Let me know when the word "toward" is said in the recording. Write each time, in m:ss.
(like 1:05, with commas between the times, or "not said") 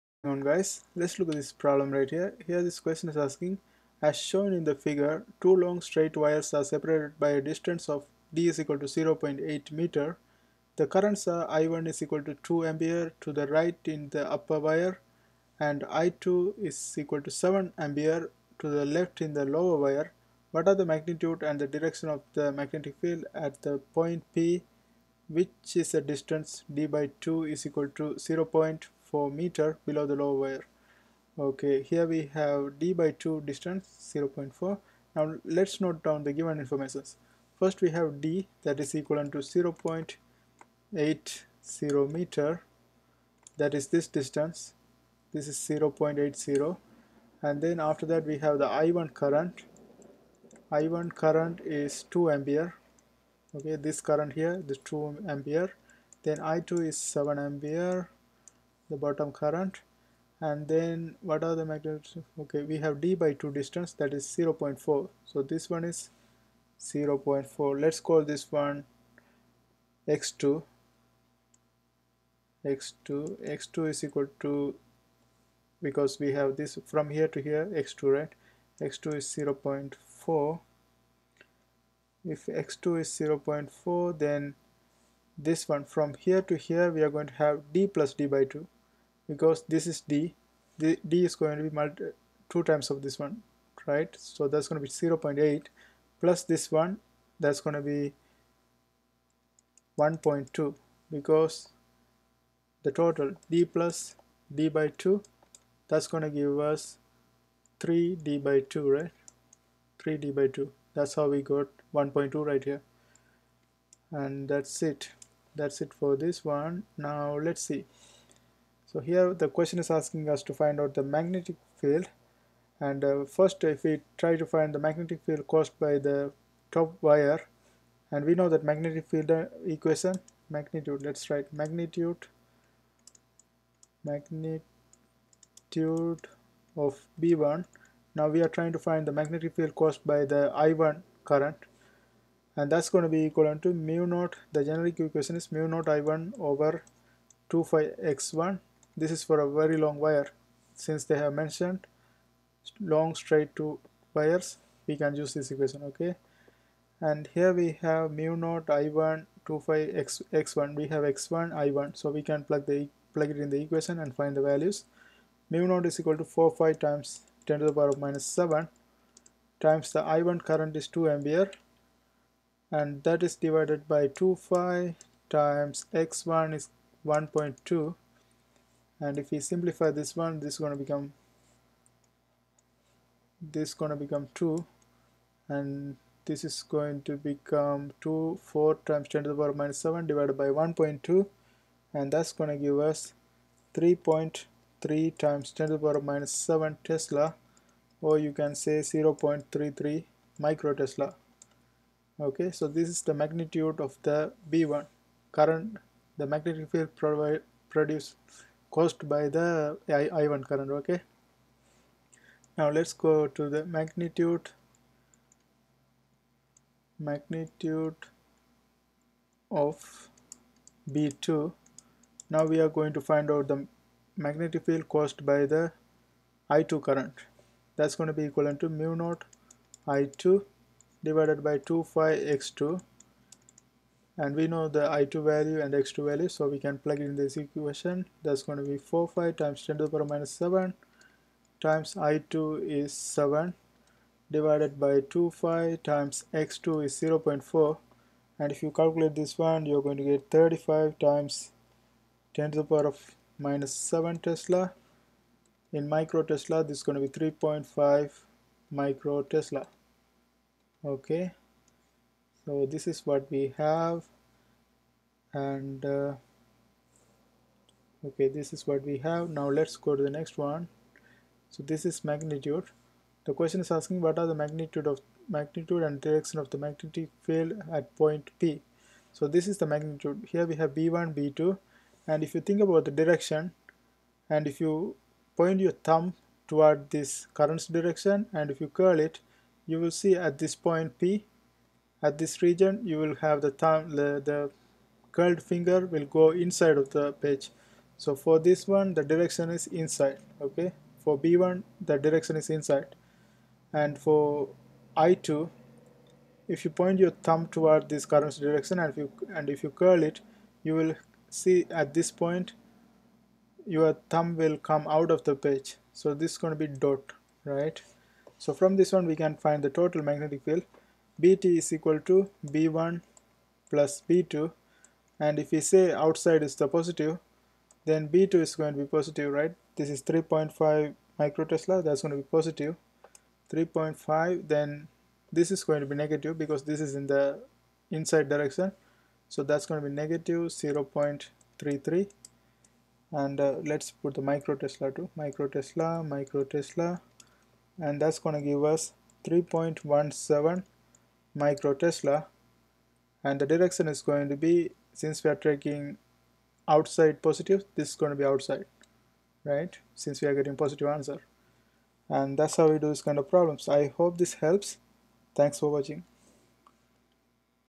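4:46, 5:07.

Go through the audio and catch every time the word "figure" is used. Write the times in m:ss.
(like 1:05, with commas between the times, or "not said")
0:04.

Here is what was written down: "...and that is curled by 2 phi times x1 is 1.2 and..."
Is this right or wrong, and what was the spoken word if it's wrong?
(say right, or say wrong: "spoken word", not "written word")
wrong: "divided", not "curled".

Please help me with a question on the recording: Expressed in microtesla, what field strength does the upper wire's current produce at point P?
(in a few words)
0.33 microtesla.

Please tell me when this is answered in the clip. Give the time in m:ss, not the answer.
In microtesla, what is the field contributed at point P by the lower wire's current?
4:17.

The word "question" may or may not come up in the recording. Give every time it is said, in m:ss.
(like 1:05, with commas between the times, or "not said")
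0:02, 1:59, 4:33.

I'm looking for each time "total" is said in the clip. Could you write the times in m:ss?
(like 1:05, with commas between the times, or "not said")
1:42, 5:19.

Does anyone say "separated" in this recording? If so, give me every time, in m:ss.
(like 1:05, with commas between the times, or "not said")
0:06.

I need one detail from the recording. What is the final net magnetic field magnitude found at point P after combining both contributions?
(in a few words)
3.17 microtesla.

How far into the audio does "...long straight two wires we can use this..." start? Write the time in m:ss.
2:32.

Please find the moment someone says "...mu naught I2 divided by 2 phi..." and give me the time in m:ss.
3:48.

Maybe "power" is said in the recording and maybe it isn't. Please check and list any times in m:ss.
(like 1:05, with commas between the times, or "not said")
2:47, 3:09, 3:15, 3:59, 4:12.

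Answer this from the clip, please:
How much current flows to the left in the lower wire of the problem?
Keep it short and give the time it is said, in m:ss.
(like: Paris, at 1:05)
7 ampere, at 0:17.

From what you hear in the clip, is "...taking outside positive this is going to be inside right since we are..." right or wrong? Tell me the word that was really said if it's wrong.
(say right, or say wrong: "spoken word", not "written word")
wrong: "outside", not "inside".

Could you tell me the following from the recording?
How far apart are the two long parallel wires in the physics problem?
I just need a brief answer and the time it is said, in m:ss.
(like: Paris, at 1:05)
0.8 meter, at 0:08.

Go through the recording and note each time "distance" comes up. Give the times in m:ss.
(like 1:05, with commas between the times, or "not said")
0:07, 0:26, 0:33, 0:44, 1:03.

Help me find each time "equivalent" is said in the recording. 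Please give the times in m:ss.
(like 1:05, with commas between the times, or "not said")
0:38, 2:23, 3:48.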